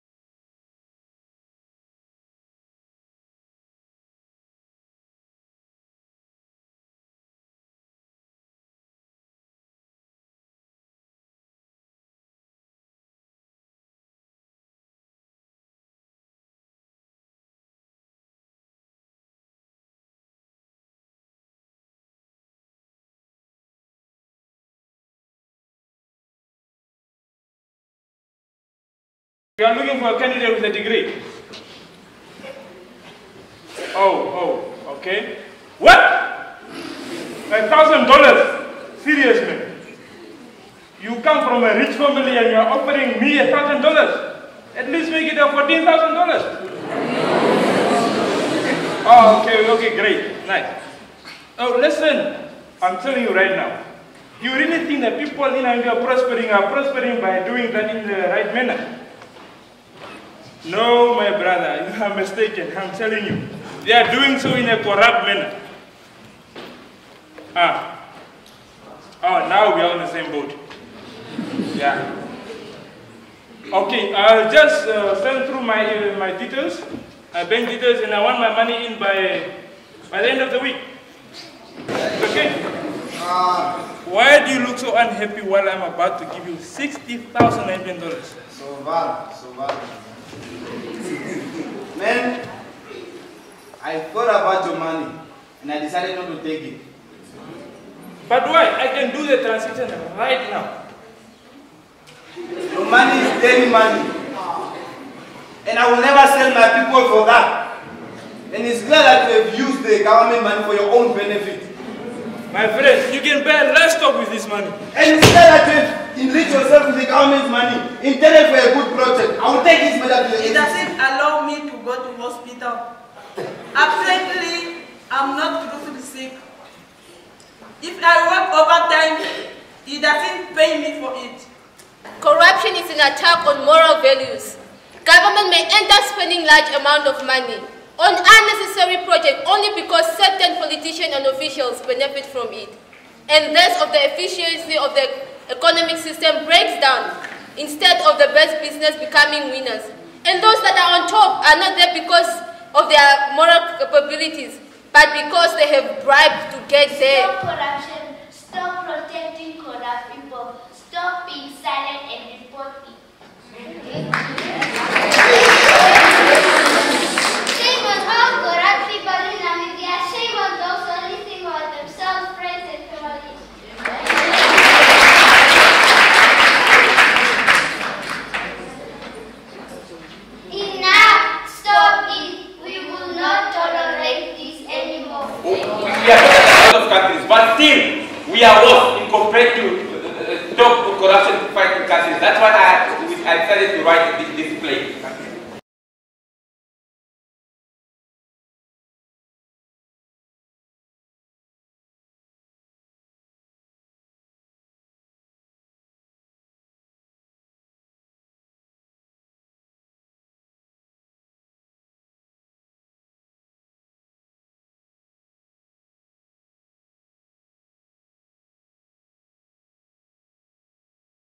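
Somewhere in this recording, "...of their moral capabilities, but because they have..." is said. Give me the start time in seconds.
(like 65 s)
152 s.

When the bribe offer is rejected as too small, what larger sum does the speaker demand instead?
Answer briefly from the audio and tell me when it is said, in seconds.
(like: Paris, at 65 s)
$14,000, at 45 s.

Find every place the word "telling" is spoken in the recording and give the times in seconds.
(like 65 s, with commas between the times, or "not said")
53 s, 62 s.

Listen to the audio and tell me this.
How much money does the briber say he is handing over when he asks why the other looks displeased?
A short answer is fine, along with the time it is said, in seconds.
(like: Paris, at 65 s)
$60,000, at 86 s.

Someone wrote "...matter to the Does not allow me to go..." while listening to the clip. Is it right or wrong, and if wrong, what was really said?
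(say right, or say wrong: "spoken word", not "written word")
right.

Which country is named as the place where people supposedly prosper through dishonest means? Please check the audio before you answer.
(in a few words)
India.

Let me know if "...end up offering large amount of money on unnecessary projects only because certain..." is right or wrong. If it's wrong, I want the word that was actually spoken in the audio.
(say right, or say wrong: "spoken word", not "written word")
wrong: "spending", not "offering".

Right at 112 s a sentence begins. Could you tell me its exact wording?
My friend, you can buy less stock with this money.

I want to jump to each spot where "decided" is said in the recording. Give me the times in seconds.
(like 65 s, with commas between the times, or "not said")
95 s, 193 s.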